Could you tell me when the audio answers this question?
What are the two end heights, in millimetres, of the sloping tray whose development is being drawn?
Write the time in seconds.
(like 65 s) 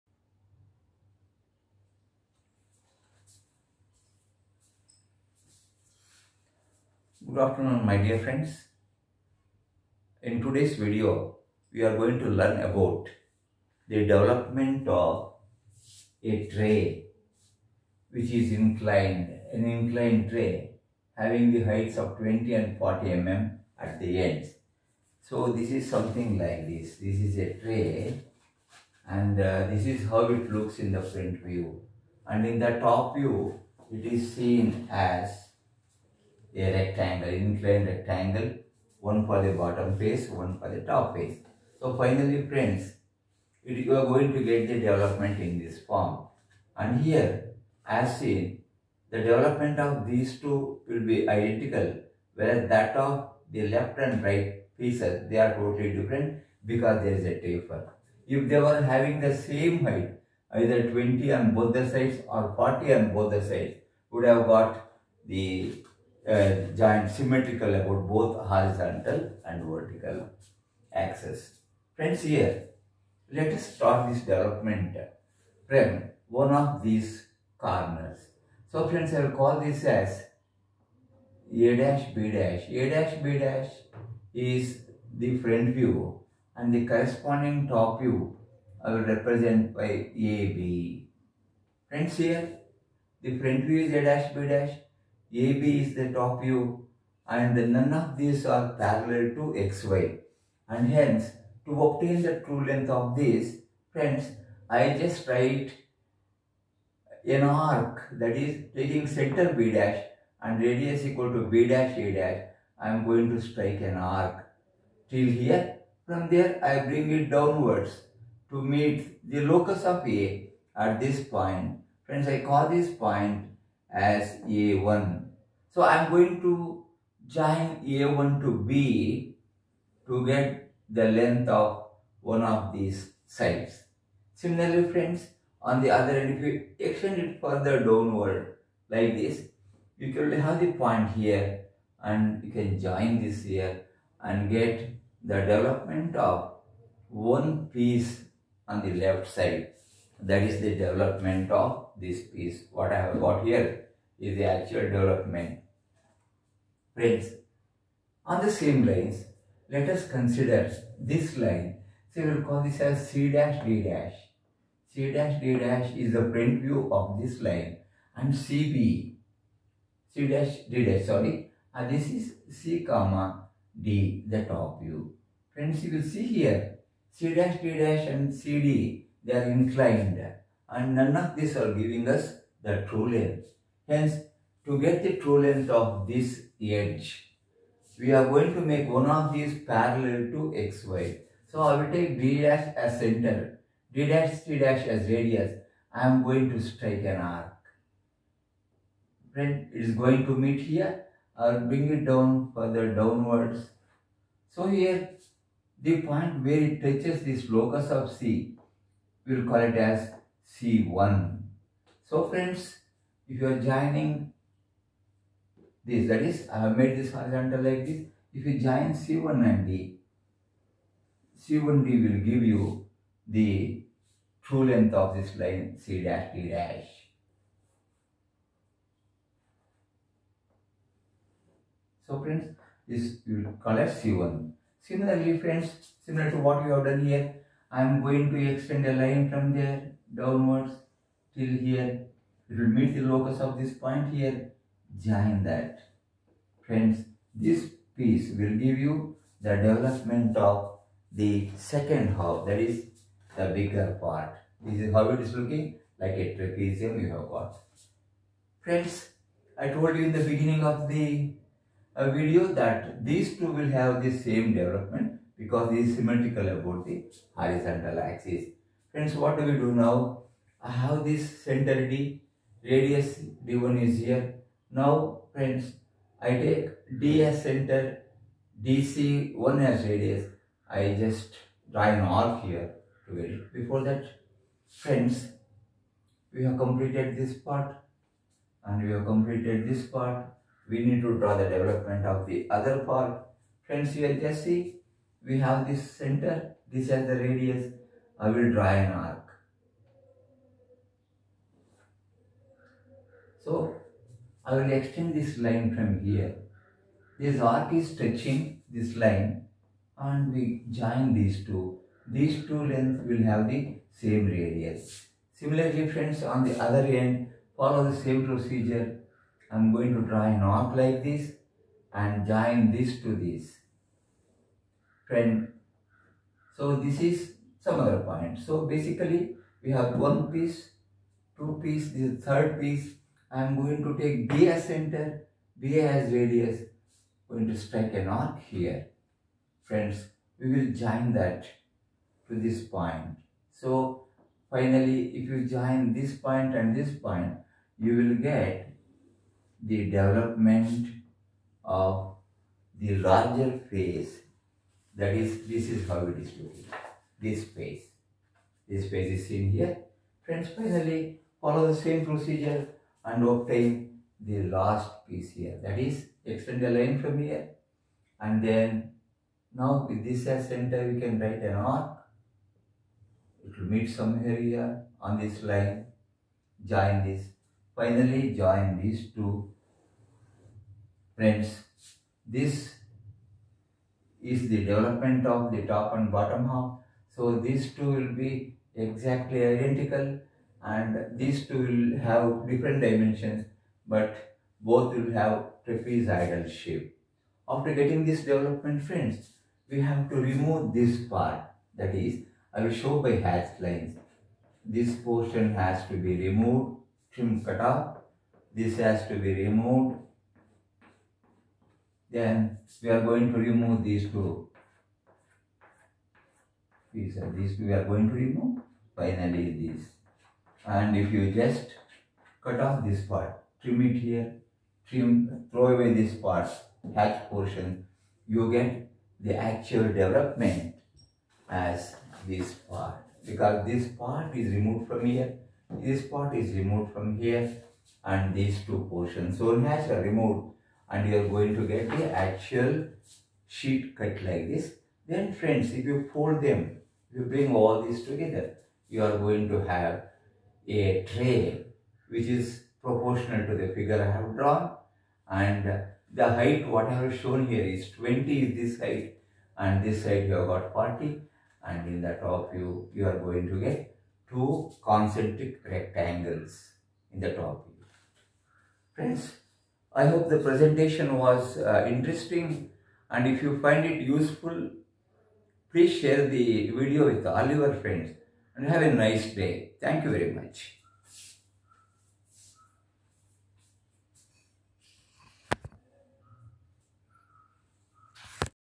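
22 s.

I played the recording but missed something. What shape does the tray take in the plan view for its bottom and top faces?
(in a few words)
inclined rectangle.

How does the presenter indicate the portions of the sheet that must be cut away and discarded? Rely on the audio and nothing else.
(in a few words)
hatch lines.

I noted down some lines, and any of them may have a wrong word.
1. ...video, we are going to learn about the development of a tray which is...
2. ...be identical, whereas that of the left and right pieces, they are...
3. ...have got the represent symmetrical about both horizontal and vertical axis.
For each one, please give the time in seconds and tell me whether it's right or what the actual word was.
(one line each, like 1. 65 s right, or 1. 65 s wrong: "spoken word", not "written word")
1. 10 s right
2. 51 s right
3. 64 s wrong: "joint", not "represent".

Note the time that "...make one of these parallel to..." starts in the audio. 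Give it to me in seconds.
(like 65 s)
188 s.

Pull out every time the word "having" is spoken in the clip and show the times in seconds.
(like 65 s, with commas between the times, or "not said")
21 s, 58 s.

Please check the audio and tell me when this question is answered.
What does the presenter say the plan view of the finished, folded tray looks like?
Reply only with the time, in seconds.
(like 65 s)
464 s.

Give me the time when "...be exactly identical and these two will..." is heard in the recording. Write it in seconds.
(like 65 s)
388 s.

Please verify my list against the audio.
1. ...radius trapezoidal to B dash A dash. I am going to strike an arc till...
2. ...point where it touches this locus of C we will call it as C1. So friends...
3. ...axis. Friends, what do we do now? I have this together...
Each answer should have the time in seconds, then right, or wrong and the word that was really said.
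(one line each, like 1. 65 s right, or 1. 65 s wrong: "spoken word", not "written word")
1. 110 s wrong: "equal", not "trapezoidal"
2. 206 s right
3. 267 s wrong: "center", not "together".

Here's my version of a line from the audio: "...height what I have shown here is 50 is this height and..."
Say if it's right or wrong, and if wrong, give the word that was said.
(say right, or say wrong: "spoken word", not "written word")
wrong: "20", not "50".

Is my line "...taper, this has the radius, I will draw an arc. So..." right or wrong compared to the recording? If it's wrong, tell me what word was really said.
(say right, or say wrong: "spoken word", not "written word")
wrong: "center", not "taper".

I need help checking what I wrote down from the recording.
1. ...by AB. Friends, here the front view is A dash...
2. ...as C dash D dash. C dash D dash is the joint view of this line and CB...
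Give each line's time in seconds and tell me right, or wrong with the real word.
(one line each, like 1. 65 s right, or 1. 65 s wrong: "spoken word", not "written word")
1. 89 s right
2. 162 s wrong: "front", not "joint".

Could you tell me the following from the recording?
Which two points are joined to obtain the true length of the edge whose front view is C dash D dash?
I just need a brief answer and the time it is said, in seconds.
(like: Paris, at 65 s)
C1 and D, at 218 s.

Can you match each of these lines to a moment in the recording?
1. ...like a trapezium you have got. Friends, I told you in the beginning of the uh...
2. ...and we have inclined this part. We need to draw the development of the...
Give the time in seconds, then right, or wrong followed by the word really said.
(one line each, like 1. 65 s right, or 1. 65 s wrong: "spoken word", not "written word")
1. 255 s right
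2. 288 s wrong: "completed", not "inclined".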